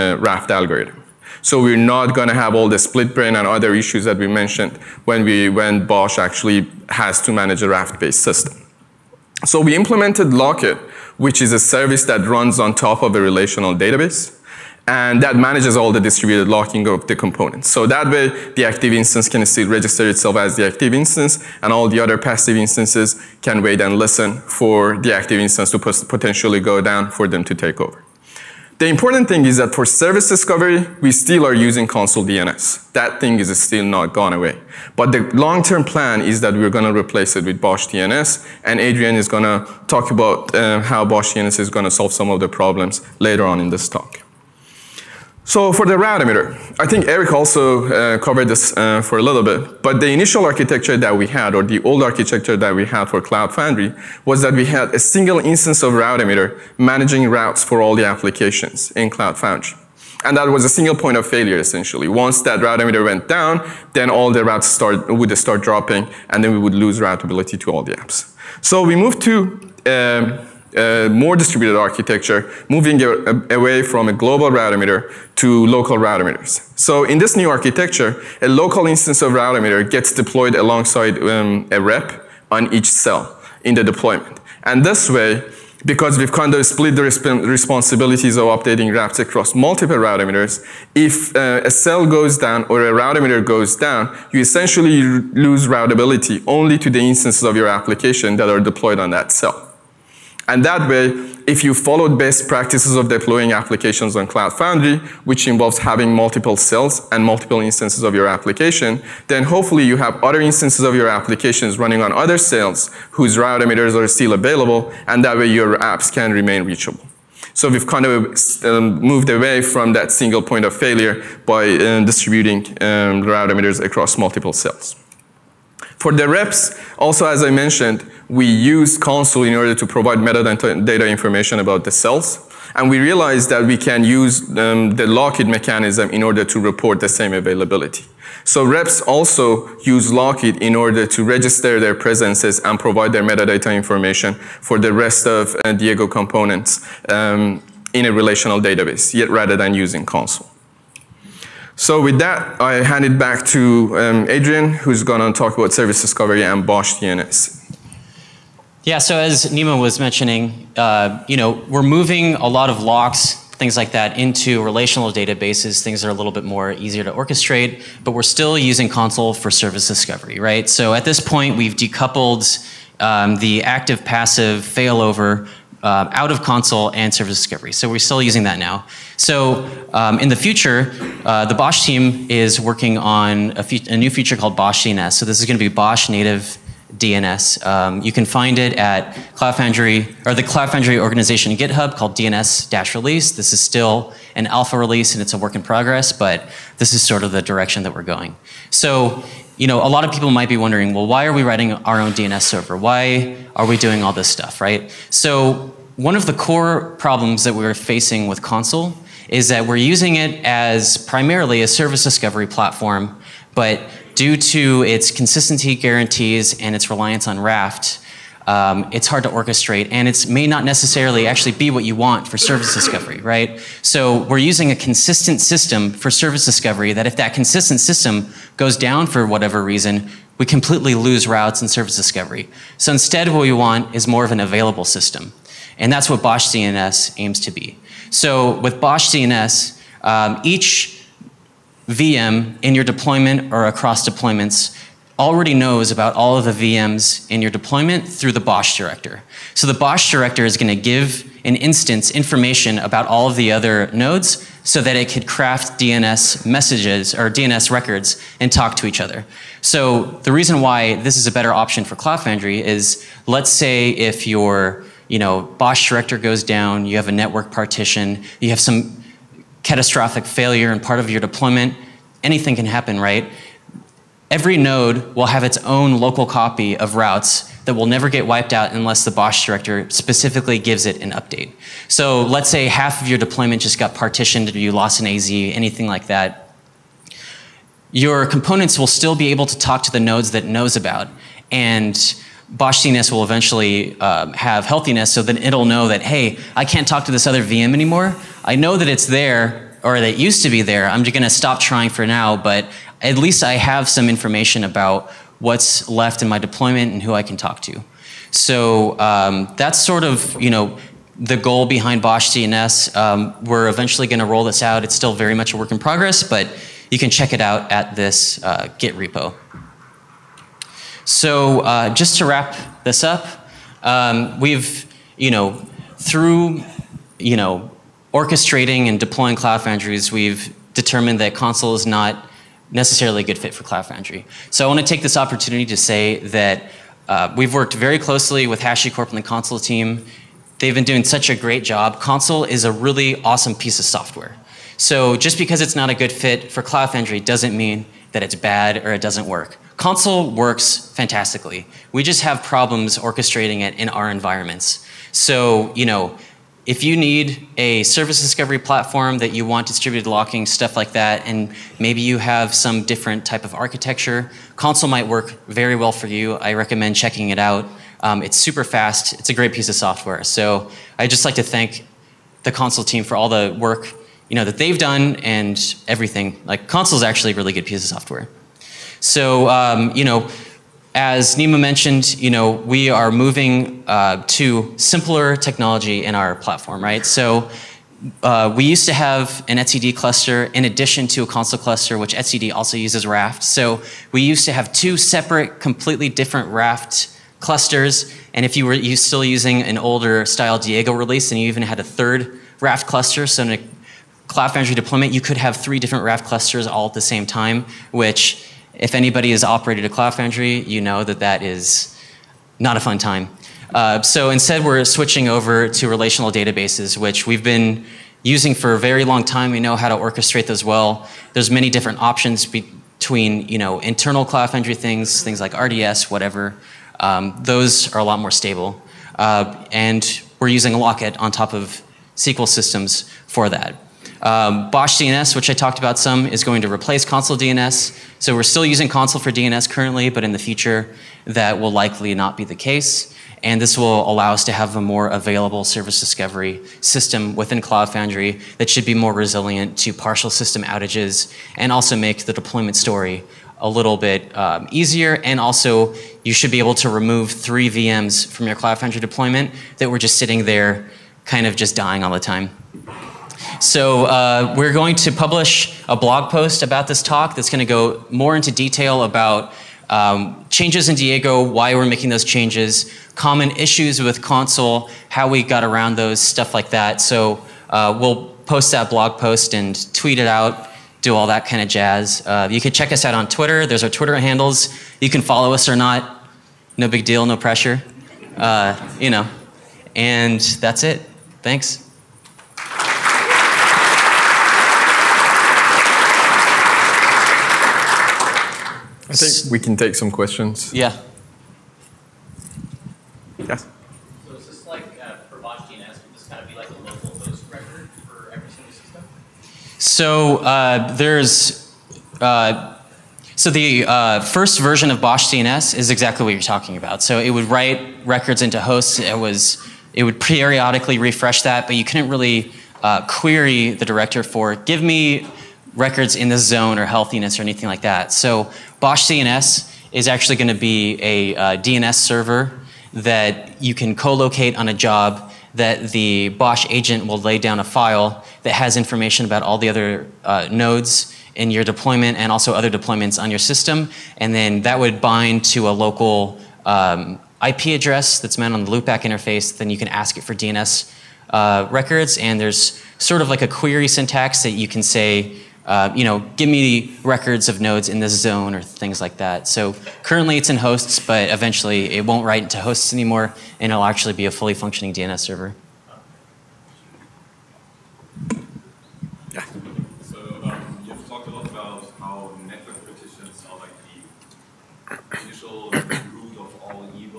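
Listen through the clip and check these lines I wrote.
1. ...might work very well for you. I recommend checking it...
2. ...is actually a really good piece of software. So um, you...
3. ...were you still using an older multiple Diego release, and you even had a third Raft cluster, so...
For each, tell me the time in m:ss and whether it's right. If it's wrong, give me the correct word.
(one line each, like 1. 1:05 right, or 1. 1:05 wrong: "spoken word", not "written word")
1. 6:04 right
2. 6:16 right
3. 6:38 wrong: "style", not "multiple".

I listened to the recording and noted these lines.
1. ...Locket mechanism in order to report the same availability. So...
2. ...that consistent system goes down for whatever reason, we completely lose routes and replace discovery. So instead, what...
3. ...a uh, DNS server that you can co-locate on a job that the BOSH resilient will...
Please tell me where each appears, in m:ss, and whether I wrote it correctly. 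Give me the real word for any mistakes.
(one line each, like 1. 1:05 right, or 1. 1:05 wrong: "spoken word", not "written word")
1. 2:15 right
2. 3:47 wrong: "service", not "replace"
3. 8:51 wrong: "agent", not "resilient".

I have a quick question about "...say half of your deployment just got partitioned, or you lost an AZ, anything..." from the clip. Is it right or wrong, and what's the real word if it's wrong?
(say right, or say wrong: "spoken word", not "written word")
right.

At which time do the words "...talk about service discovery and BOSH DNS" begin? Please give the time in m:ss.
2:35.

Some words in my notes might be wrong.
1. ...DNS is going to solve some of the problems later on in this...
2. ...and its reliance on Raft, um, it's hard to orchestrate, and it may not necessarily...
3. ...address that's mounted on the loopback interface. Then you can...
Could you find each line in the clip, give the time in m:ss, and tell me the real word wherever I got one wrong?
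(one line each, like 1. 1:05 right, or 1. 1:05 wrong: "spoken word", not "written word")
1. 0:41 right
2. 3:36 right
3. 9:07 right.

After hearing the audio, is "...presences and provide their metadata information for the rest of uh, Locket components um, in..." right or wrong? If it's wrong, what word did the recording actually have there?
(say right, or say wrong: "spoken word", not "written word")
wrong: "Diego", not "Locket".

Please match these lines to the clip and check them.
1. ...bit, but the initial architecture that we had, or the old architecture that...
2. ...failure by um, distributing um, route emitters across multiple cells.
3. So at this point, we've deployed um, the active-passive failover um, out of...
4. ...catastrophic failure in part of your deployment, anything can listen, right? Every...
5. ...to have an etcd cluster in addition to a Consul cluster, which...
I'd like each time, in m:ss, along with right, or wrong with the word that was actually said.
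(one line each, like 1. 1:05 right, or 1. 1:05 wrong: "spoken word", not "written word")
1. 0:49 right
2. 2:00 right
3. 2:50 wrong: "decoupled", not "deployed"
4. 4:29 wrong: "happen", not "listen"
5. 6:28 right.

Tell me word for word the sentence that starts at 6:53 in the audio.
Uh, so instead, we're switching over to relational databases, which we've been using for a very long time.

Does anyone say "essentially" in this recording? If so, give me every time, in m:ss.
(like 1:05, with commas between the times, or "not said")
1:01, 1:34.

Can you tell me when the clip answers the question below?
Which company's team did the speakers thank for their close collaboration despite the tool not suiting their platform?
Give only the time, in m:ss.
5:38.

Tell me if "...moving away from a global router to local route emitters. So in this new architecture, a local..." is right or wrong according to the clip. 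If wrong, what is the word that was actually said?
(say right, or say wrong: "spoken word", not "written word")
right.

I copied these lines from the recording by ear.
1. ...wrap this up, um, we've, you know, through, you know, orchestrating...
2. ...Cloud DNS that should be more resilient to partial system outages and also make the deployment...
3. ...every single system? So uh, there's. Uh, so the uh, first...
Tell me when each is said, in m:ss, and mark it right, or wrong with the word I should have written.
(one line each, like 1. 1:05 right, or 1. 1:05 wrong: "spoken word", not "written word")
1. 5:22 right
2. 7:27 wrong: "Foundry", not "DNS"
3. 8:28 right.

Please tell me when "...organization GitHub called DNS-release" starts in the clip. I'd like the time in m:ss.
3:10.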